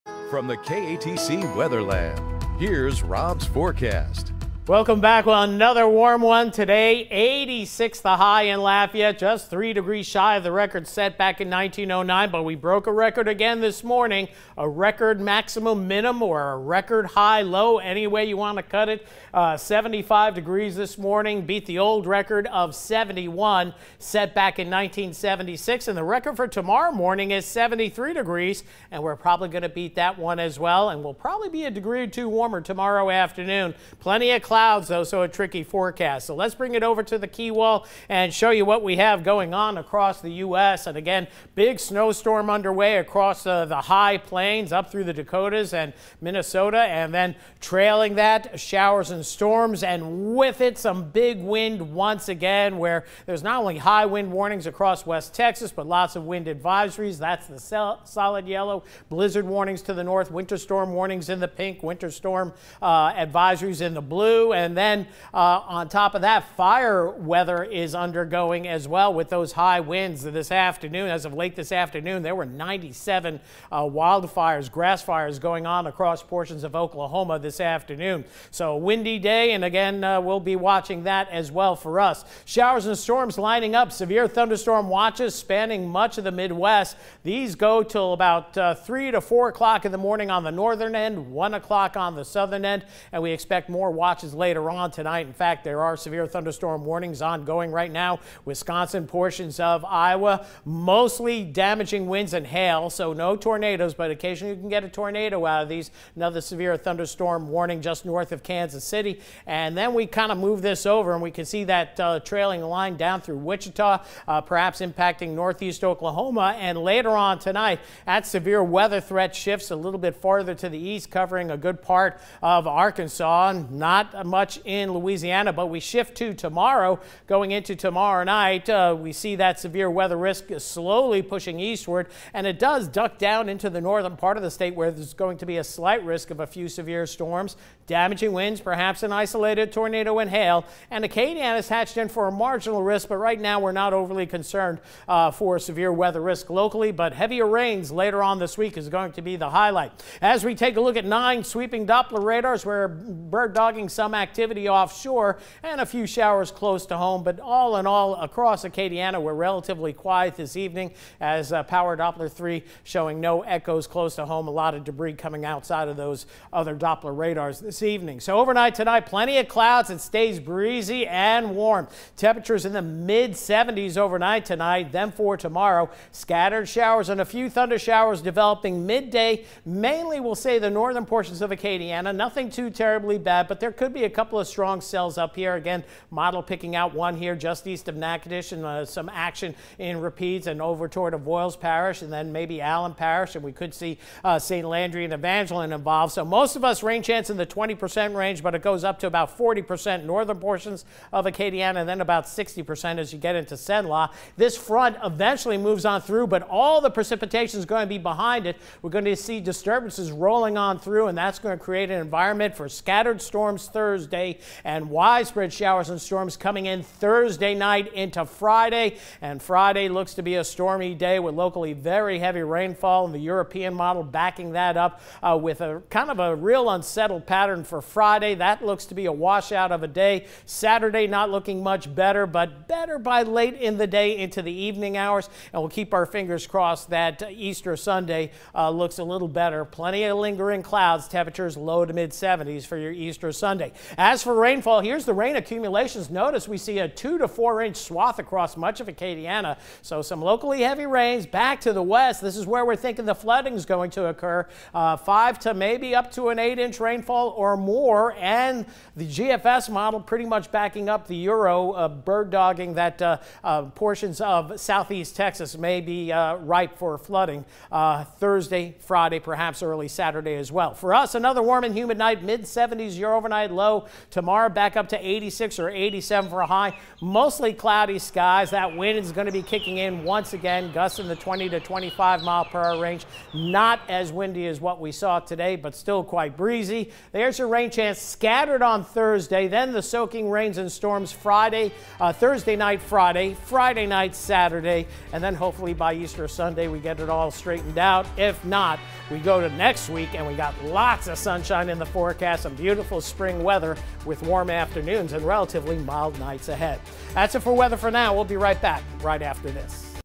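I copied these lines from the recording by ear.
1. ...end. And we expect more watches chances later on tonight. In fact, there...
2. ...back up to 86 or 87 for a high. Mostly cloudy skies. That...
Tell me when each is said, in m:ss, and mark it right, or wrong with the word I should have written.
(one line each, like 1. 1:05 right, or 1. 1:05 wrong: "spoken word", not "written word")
1. 1:32 right
2. 4:34 right.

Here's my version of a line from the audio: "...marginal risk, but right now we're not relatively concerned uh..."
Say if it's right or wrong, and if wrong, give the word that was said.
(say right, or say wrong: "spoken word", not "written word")
wrong: "overly", not "relatively".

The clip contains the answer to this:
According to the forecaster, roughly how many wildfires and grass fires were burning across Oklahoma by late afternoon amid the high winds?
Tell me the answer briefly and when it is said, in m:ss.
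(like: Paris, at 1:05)
97, at 1:12.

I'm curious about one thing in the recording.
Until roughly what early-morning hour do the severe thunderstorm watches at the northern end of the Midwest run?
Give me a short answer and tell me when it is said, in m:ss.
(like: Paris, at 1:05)
3 to 4 o'clock, at 1:28.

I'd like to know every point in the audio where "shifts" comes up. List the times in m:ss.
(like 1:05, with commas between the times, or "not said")
1:59, 2:05.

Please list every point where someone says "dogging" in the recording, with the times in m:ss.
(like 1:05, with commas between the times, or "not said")
2:33, 4:22.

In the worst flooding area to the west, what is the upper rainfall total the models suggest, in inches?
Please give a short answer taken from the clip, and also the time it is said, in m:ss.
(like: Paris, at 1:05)
8, at 4:16.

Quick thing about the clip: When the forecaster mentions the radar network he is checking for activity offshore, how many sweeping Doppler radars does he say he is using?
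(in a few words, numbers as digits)
9.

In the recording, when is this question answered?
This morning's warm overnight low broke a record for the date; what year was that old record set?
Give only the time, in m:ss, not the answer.
0:24.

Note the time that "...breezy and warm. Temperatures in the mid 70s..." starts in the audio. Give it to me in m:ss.
2:50.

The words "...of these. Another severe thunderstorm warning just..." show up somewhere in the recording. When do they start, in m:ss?
1:45.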